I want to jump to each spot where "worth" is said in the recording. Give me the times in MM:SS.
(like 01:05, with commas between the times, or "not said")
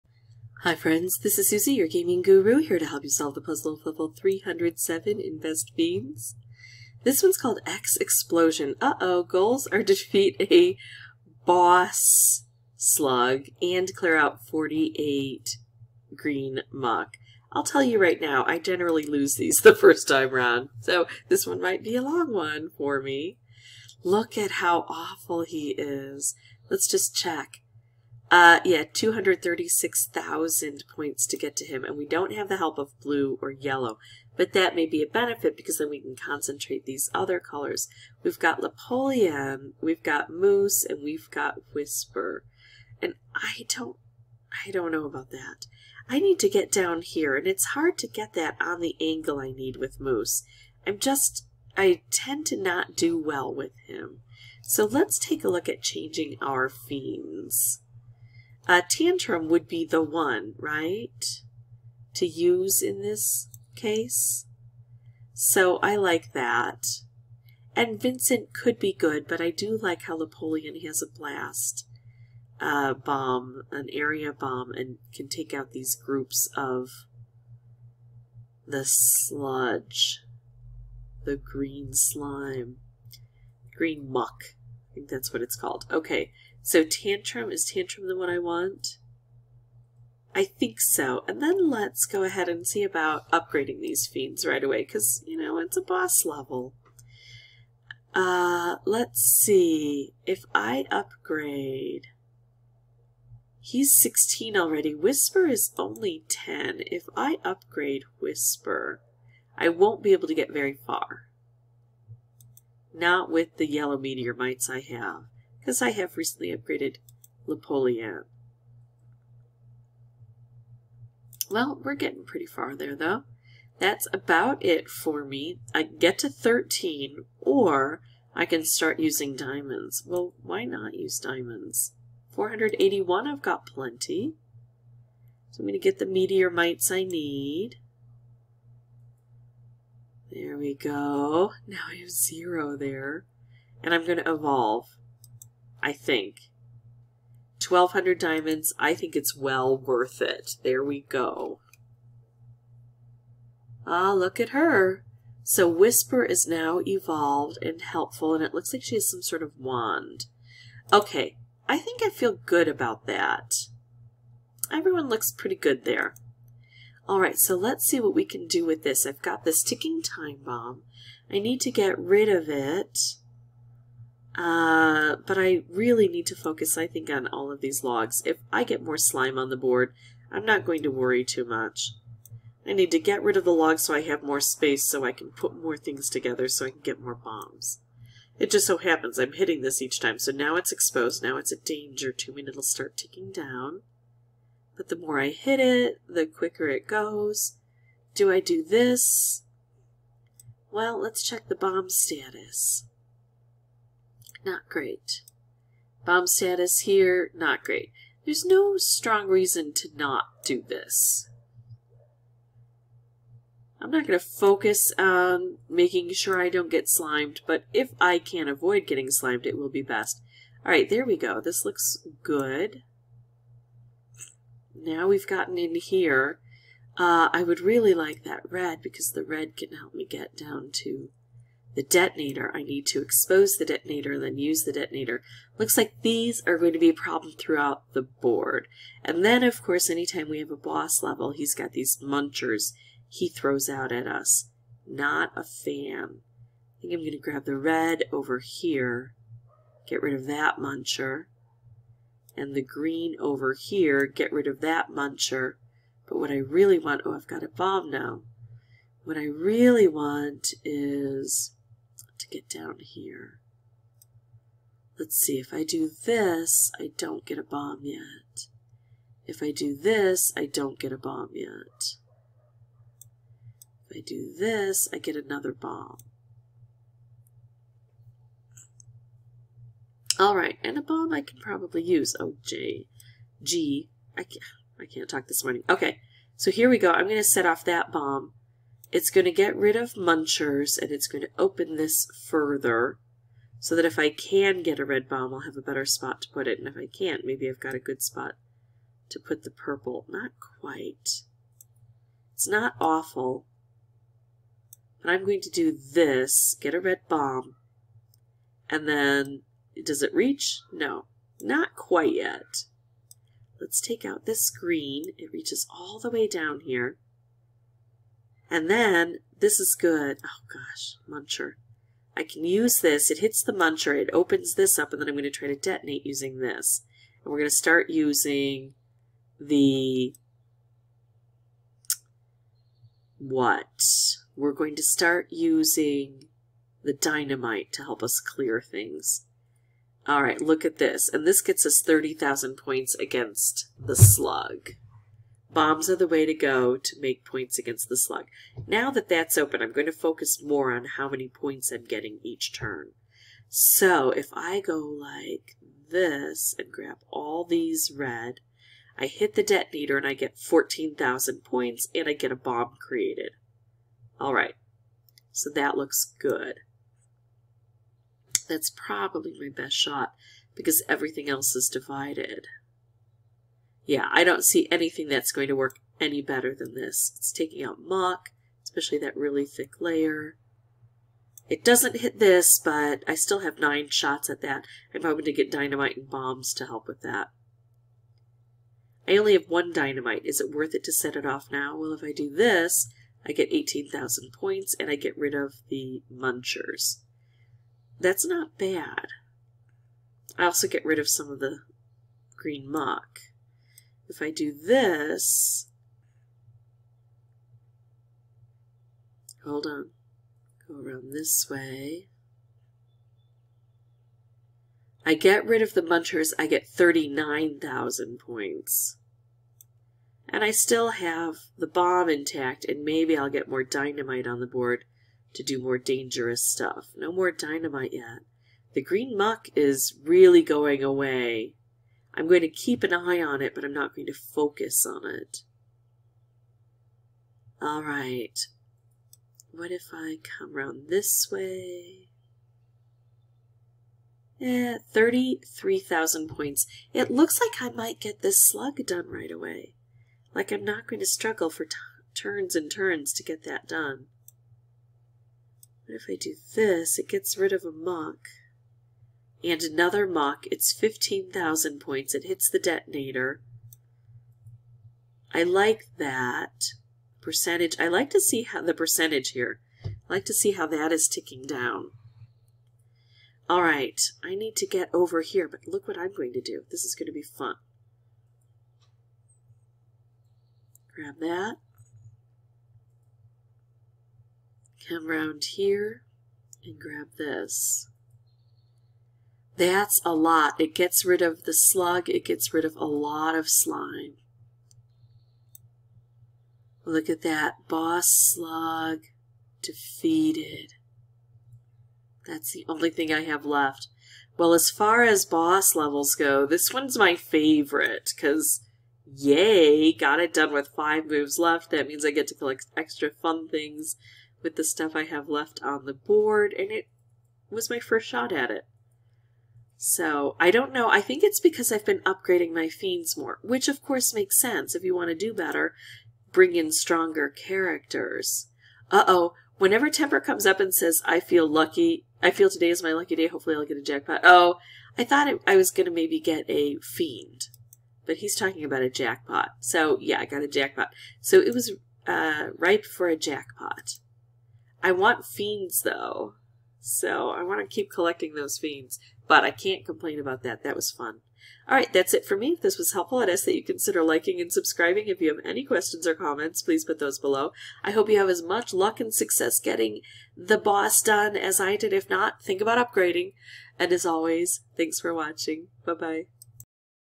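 02:29, 06:30.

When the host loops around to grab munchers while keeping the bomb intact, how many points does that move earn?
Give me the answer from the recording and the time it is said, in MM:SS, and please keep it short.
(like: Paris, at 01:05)
39,000, at 06:56.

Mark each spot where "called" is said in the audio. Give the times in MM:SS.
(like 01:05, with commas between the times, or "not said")
00:07, 01:25.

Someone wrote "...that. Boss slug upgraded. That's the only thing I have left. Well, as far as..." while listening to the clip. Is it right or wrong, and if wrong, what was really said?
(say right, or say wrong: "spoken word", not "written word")
wrong: "defeated", not "upgraded".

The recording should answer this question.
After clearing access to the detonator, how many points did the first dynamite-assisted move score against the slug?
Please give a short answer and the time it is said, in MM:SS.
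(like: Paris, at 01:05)
30,000, at 05:41.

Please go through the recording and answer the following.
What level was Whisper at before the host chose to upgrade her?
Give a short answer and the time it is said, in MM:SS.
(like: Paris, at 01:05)
10, at 01:44.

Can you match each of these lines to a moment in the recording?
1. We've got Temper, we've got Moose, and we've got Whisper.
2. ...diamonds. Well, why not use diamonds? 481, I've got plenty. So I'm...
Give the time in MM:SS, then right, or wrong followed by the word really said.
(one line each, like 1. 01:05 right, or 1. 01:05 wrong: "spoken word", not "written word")
1. 00:38 wrong: "Napoleon", not "Temper"
2. 02:09 right.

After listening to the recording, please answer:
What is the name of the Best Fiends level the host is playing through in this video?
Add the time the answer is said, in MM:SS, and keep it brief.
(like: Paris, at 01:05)
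X Explosion, at 00:07.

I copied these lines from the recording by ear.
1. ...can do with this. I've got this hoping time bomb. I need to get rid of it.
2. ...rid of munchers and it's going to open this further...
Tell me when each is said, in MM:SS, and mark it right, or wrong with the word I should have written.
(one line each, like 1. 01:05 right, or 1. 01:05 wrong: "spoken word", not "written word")
1. 02:48 wrong: "ticking", not "hoping"
2. 04:49 right.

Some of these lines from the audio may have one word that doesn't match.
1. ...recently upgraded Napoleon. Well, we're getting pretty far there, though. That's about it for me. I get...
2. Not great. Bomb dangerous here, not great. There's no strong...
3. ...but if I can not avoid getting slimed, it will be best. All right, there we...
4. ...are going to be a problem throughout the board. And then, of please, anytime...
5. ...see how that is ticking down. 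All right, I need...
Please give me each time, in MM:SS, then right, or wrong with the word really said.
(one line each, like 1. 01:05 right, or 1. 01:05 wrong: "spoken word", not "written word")
1. 01:56 right
2. 03:24 wrong: "status", not "dangerous"
3. 03:37 right
4. 03:56 wrong: "course", not "please"
5. 07:50 right.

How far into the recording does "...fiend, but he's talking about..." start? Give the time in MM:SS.
08:56.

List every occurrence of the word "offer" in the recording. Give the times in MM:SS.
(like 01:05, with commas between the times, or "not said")
not said.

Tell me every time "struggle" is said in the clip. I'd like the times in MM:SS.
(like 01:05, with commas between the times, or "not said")
07:31.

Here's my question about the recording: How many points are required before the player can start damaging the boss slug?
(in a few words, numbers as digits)
236,000.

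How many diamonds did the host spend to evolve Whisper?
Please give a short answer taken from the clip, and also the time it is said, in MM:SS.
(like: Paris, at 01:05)
1200, at 02:27.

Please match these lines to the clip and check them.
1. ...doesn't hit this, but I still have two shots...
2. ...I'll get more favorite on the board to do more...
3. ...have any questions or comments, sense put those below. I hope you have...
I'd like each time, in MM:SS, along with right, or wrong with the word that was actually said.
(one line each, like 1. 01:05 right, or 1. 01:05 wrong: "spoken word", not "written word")
1. 06:21 wrong: "nine", not "two"
2. 07:03 wrong: "dynamite", not "favorite"
3. 09:15 wrong: "please", not "sense".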